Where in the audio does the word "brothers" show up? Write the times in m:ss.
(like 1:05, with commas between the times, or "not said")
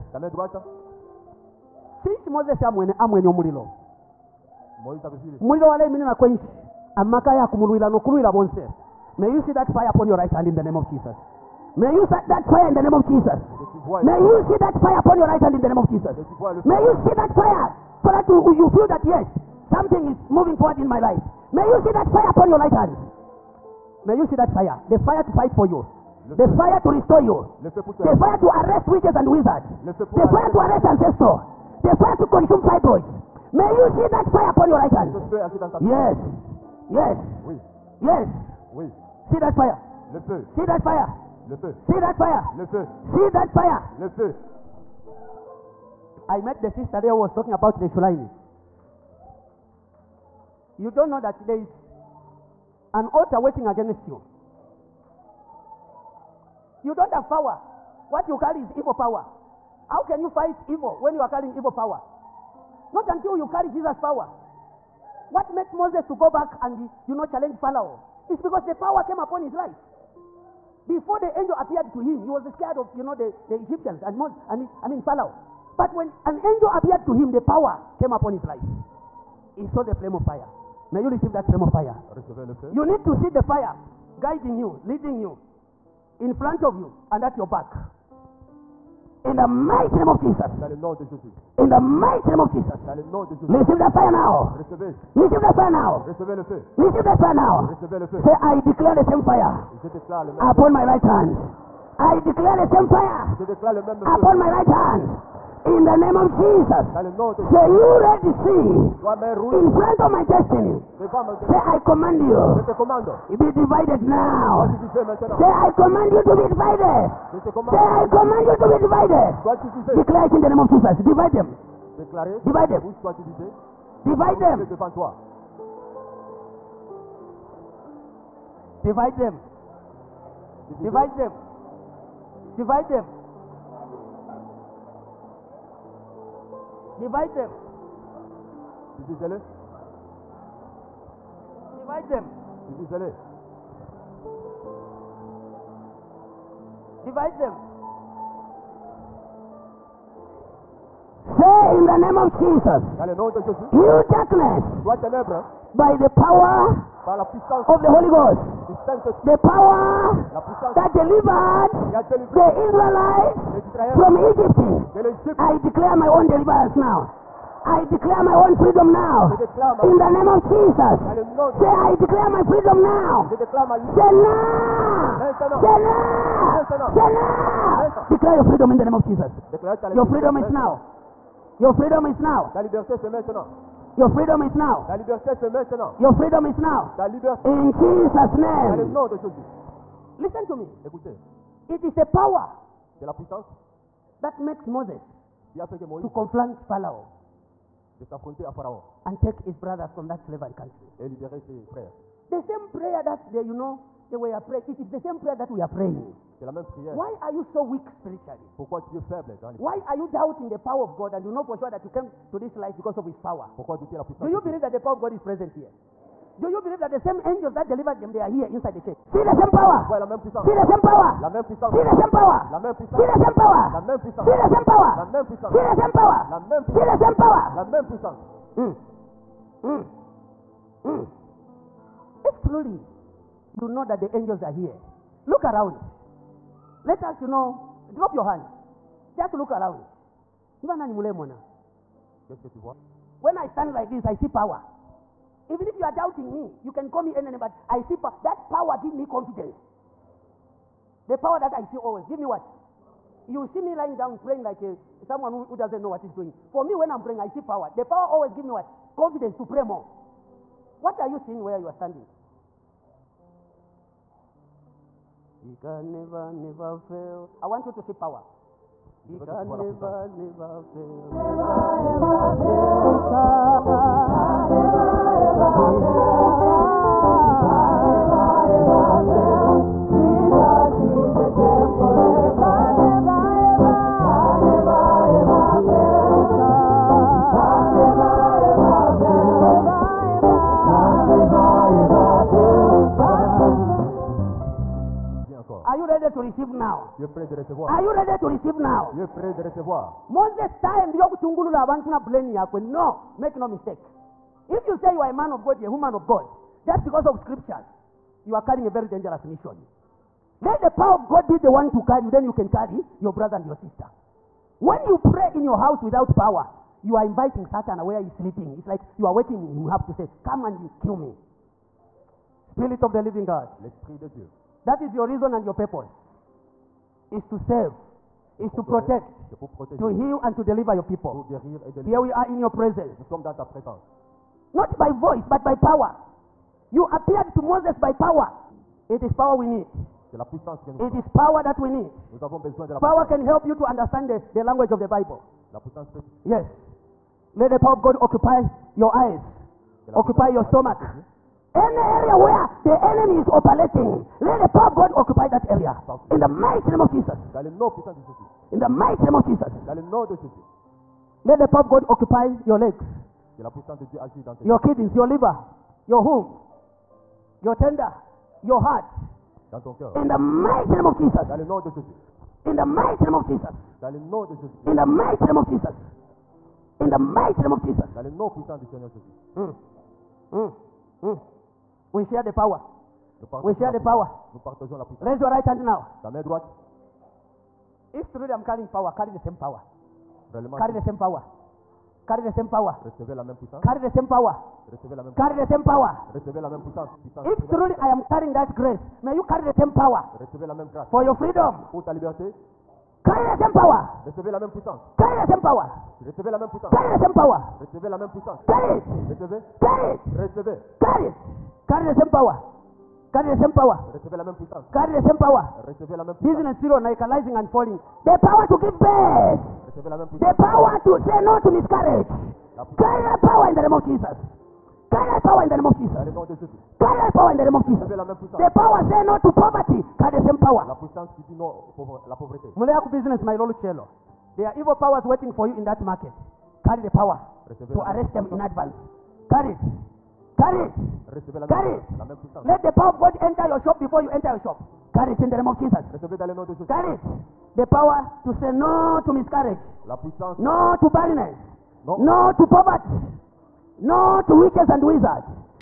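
3:19, 5:13.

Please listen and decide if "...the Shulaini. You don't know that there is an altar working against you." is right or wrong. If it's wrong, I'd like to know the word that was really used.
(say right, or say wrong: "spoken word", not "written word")
right.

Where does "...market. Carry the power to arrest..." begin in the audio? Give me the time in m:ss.
7:15.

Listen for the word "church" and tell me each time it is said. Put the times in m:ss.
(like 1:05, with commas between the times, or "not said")
3:38.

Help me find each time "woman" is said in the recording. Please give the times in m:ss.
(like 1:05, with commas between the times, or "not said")
5:05.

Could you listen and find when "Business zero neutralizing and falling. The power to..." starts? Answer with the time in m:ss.
6:56.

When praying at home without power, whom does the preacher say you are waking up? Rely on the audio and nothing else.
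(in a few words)
Satan.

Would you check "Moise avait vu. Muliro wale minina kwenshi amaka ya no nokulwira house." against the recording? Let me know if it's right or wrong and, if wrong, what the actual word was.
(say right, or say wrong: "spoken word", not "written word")
wrong: "bonse", not "house".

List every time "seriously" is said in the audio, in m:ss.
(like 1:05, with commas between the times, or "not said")
not said.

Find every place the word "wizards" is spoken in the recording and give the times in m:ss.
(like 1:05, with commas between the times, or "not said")
0:29, 7:34.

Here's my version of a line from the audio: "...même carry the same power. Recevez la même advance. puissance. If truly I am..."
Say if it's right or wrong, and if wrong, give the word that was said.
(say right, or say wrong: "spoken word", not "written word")
wrong: "puissance", not "advance".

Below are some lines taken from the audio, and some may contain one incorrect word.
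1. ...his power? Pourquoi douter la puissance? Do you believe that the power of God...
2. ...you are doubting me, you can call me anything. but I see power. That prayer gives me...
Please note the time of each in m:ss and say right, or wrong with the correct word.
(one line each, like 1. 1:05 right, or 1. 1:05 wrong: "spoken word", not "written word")
1. 3:33 right
2. 4:05 wrong: "power", not "prayer".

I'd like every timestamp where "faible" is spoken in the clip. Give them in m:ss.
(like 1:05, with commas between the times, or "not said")
3:29.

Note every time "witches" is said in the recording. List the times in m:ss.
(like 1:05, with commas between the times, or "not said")
0:28, 7:34.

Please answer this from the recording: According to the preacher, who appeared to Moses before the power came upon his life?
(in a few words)
an angel.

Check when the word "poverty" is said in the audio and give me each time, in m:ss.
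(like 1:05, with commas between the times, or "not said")
7:09, 7:32.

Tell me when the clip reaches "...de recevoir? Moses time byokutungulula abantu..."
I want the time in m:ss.
4:59.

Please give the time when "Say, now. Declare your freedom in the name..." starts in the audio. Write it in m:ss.
2:56.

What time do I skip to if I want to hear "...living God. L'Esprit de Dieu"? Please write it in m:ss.
5:23.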